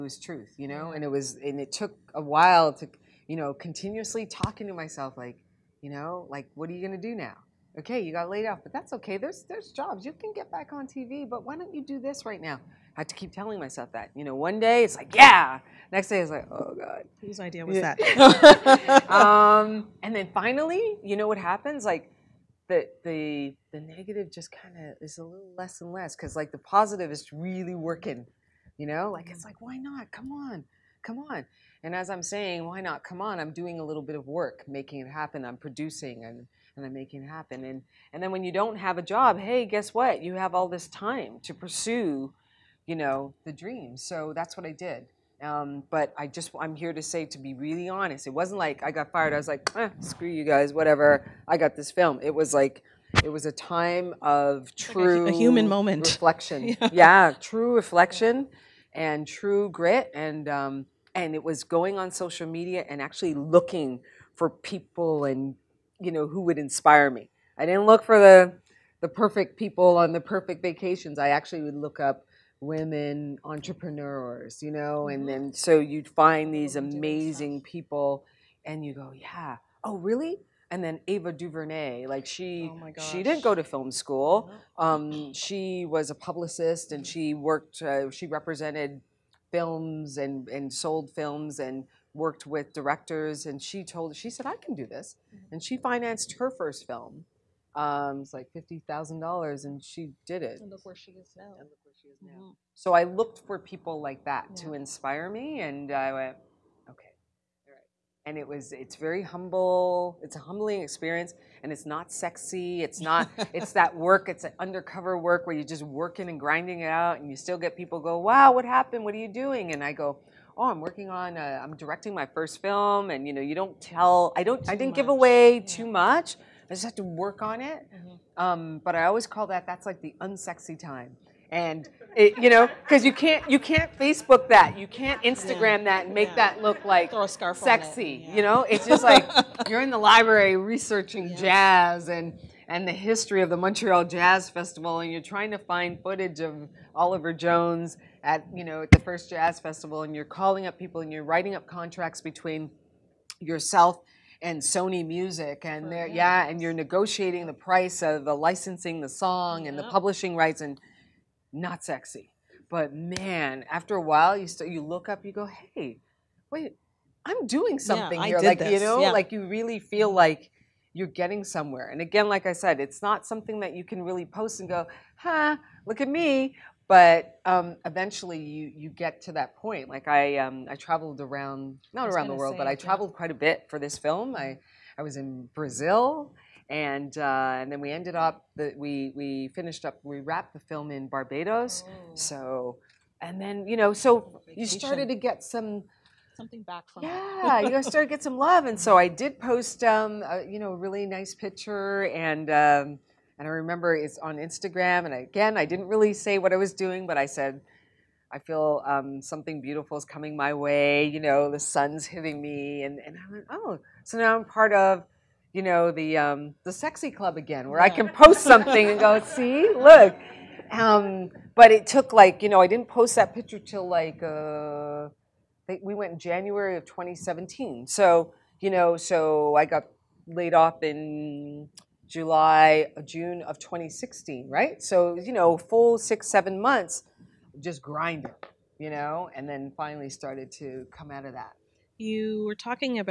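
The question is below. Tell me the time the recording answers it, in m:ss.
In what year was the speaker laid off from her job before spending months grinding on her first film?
3:53.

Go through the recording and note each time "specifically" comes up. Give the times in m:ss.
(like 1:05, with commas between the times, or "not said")
not said.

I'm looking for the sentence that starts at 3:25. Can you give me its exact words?
And again, I didn't really say what I was doing, but I said, I feel um, something beautiful is coming my way.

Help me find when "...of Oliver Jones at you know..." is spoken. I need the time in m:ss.
2:26.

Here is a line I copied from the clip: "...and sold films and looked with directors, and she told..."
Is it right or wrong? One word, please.
wrong.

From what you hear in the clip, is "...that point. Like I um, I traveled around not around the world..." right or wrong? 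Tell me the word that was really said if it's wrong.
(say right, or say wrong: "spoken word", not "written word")
right.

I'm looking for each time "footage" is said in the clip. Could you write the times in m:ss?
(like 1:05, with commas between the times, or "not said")
2:26.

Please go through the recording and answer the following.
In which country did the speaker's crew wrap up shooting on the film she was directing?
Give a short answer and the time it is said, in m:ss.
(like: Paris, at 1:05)
Barbados, at 3:11.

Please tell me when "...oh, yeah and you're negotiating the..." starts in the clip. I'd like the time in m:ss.
2:35.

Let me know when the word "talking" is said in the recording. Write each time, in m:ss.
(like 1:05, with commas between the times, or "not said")
0:04, 4:02.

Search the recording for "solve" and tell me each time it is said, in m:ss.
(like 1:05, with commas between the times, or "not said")
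not said.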